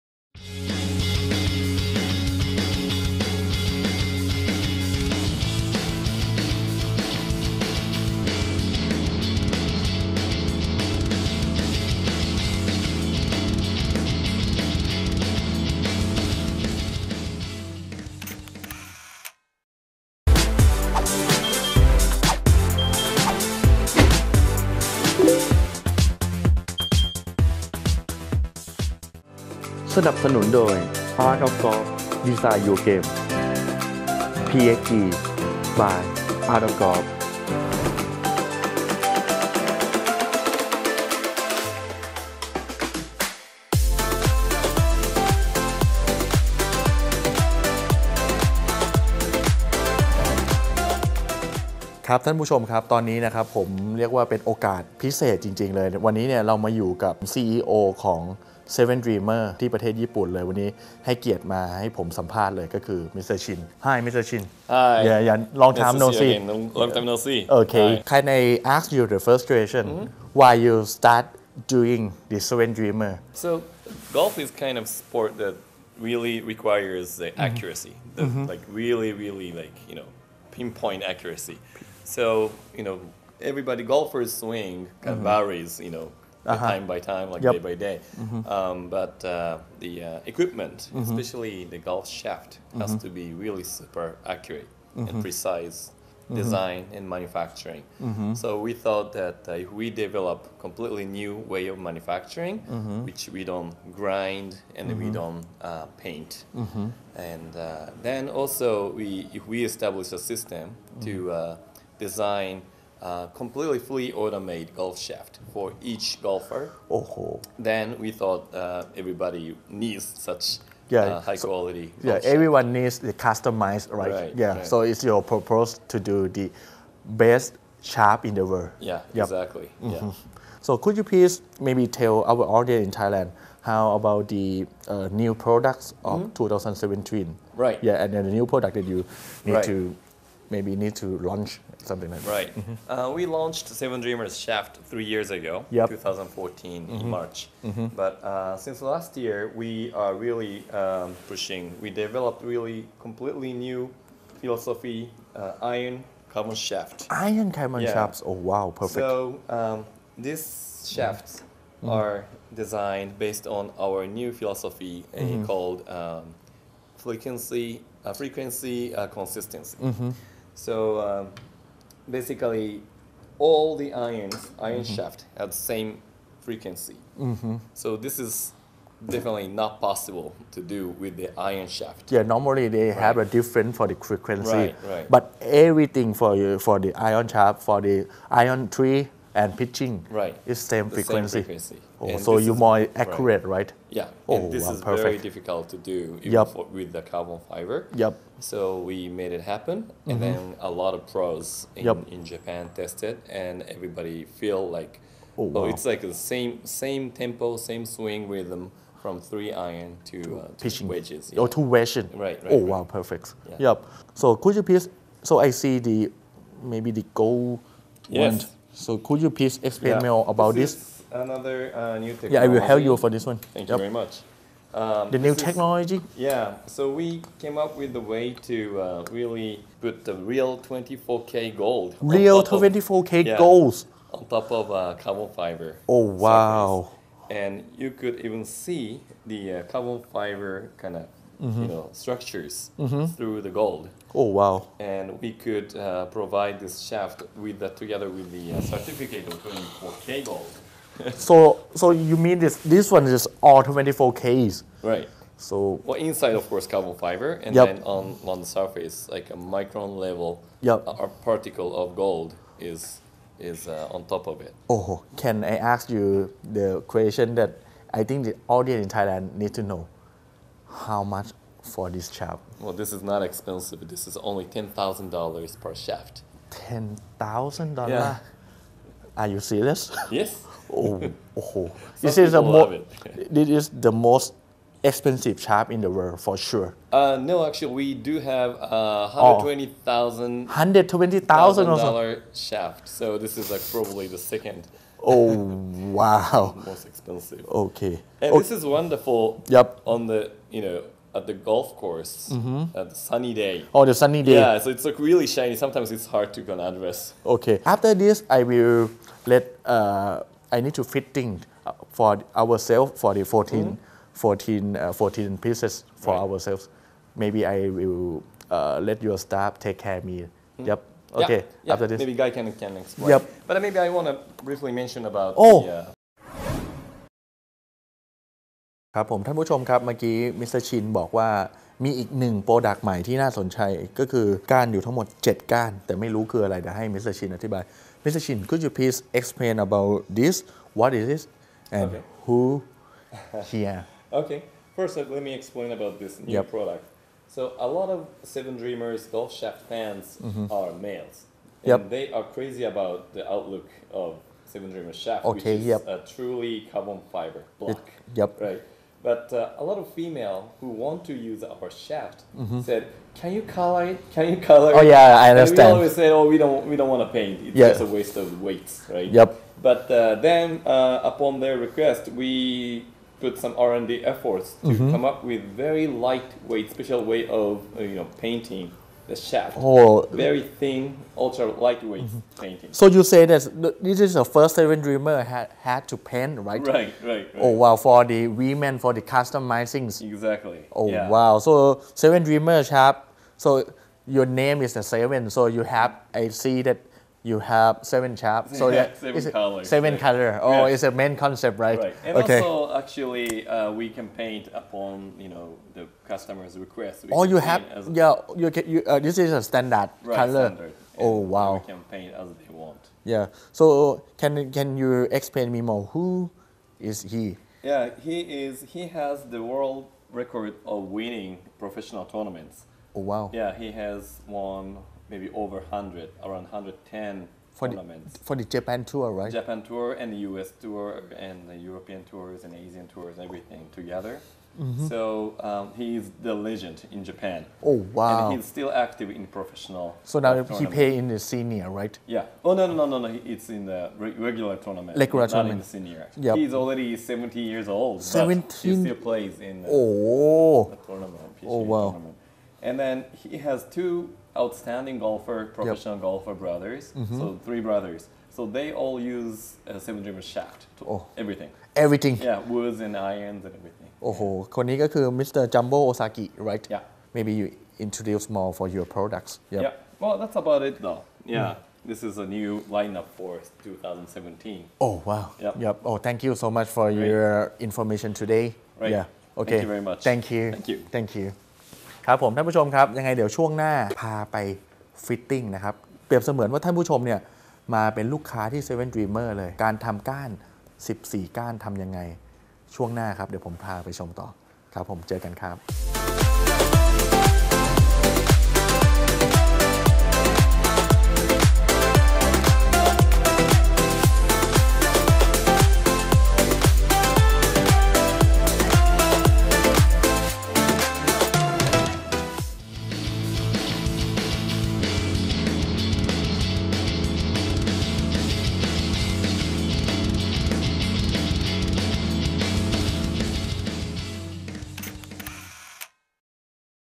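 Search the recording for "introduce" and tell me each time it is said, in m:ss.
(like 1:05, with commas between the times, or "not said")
7:47.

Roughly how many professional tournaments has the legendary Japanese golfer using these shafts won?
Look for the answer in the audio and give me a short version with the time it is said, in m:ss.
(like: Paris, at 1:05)
110, at 7:06.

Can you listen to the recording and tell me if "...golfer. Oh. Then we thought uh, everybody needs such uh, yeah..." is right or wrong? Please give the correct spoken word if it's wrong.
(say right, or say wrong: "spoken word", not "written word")
right.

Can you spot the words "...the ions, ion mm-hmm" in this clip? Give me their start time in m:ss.
2:53.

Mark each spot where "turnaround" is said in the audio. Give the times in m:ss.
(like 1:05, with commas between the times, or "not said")
not said.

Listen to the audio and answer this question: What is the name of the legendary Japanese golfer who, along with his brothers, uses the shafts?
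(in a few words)
Jumbo Osaki.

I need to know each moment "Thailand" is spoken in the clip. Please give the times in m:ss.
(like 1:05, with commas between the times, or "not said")
2:12, 4:28.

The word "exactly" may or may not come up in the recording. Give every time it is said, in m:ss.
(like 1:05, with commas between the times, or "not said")
2:09, 6:30.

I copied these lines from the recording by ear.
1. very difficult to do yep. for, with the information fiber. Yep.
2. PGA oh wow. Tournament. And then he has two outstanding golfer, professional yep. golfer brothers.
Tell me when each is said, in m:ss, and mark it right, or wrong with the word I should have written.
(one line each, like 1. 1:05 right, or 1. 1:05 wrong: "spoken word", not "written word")
1. 3:15 wrong: "carbon", not "information"
2. 7:31 right.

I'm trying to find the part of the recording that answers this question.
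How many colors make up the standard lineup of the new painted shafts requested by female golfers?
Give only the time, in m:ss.
6:38.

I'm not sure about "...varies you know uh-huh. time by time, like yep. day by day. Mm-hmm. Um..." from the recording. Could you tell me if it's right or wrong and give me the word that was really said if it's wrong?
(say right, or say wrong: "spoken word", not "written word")
right.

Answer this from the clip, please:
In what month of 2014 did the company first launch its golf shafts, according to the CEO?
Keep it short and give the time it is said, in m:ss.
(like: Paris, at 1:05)
March, at 2:27.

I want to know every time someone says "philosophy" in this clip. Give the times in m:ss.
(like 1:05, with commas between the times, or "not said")
2:34, 2:44.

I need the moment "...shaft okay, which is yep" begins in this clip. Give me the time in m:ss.
5:55.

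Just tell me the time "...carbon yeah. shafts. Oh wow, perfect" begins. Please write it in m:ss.
2:37.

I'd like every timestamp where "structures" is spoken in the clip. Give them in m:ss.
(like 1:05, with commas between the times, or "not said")
4:01.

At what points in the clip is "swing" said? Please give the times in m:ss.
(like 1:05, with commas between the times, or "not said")
1:24, 3:27.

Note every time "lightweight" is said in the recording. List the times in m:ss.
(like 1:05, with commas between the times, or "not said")
6:15, 6:21.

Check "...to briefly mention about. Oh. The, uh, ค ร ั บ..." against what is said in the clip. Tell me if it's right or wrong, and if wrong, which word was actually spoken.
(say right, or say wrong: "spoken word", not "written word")
right.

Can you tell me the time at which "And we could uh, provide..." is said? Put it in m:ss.
4:04.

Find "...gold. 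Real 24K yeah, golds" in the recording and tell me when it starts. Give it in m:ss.
3:51.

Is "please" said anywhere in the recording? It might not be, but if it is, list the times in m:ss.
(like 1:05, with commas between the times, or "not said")
2:11, 3:34, 3:39, 5:38.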